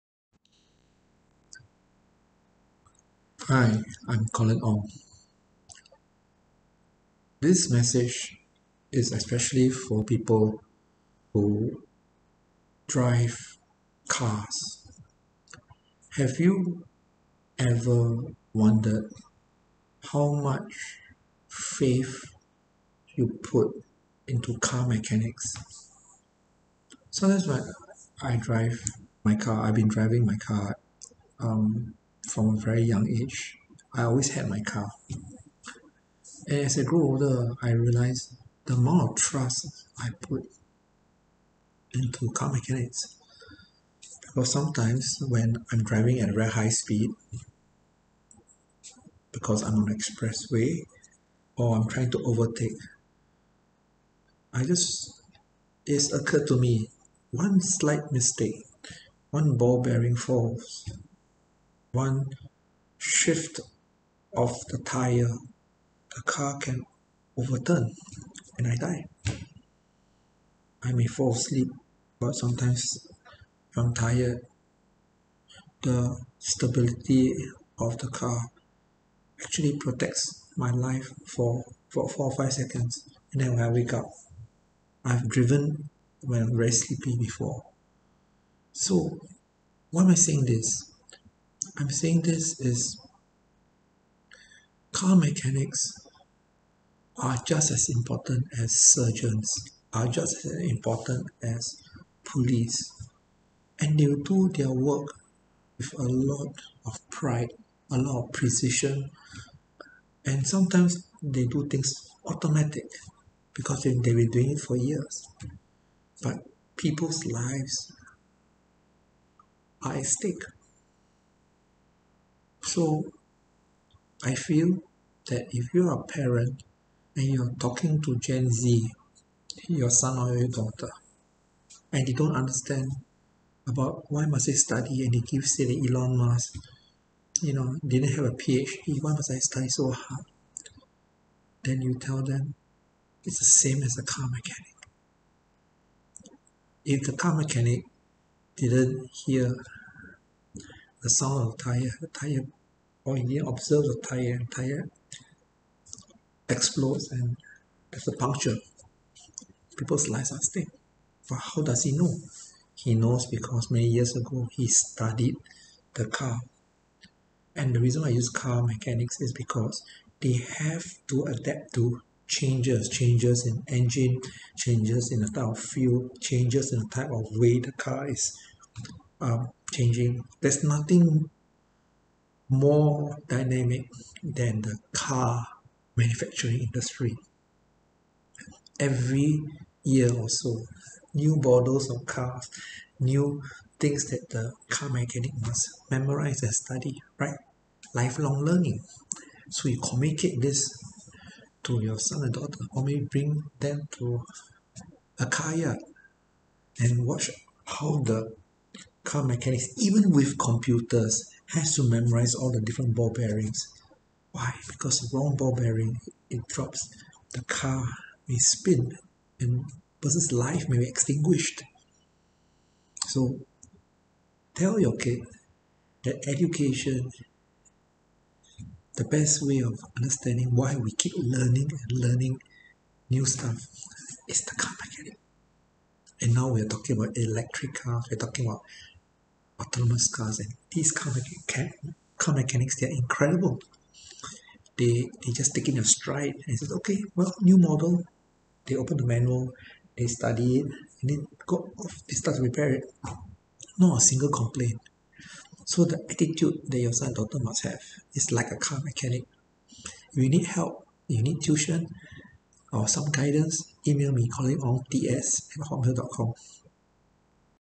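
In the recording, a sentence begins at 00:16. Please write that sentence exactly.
Have you ever wondered how much faith you put into car mechanics?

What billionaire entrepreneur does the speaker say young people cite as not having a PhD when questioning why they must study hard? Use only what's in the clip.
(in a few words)
Elon Musk.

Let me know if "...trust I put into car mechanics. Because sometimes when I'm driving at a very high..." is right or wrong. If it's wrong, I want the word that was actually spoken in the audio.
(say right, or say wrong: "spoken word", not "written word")
right.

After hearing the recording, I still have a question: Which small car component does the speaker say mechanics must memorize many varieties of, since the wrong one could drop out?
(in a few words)
Ball bearings.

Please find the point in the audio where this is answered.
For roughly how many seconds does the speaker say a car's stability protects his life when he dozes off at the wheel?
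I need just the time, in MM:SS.
01:22.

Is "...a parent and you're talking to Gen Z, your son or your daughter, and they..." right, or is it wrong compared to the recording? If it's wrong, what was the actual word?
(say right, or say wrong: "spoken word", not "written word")
right.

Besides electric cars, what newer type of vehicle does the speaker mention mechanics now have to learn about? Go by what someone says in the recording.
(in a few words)
Autonomous cars.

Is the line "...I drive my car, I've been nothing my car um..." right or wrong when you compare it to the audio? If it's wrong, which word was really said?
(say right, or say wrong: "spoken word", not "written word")
wrong: "driving", not "nothing".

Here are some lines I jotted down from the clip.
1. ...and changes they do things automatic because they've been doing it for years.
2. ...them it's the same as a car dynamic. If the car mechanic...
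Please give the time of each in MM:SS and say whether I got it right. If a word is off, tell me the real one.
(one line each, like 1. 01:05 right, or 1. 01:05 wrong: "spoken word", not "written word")
1. 01:50 wrong: "sometimes", not "changes"
2. 02:22 wrong: "mechanic", not "dynamic".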